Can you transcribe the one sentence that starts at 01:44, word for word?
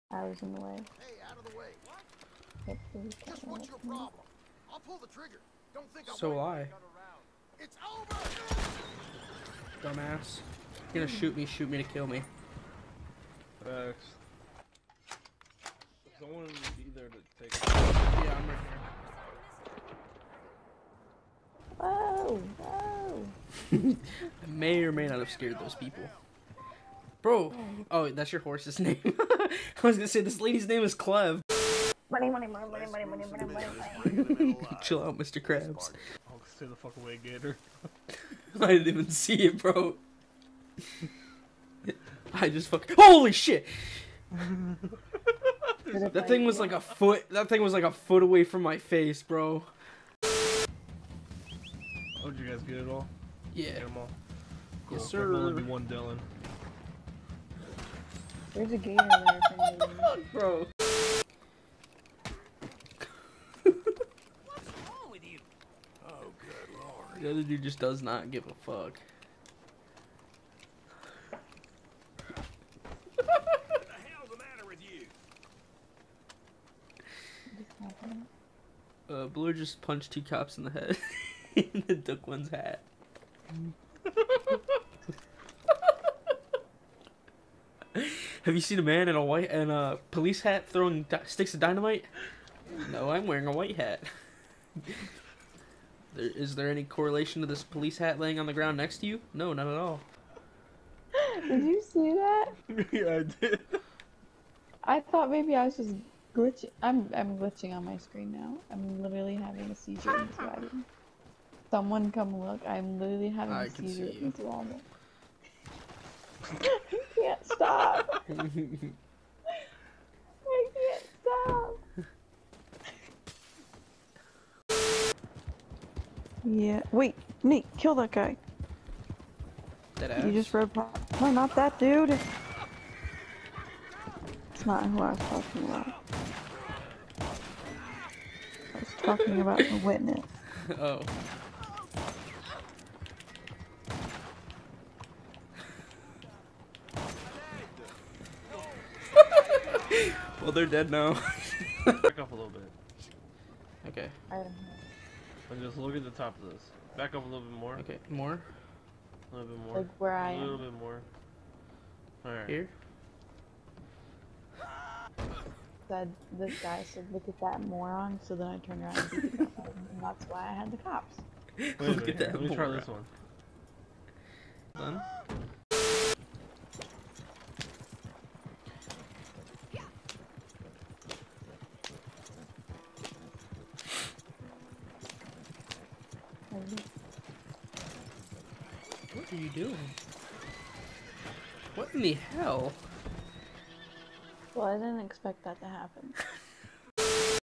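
I thought maybe I was just glitching.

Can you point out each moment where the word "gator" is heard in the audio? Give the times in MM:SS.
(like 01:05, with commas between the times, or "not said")
00:37, 00:58.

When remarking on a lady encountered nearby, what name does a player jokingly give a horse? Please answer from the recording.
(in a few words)
Clev.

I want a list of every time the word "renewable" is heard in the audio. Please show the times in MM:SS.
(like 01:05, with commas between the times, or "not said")
not said.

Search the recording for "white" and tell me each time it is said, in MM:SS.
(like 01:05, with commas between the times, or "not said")
01:29, 01:33.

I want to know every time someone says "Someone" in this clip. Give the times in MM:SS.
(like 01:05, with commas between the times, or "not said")
00:16, 01:51.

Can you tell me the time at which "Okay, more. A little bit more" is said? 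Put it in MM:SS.
02:37.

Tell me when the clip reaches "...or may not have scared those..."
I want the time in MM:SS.
00:24.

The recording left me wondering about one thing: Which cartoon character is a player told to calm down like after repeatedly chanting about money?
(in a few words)
Mr. Krabs.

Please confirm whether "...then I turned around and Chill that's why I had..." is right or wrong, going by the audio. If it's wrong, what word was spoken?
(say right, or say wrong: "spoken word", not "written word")
wrong: "And", not "Chill".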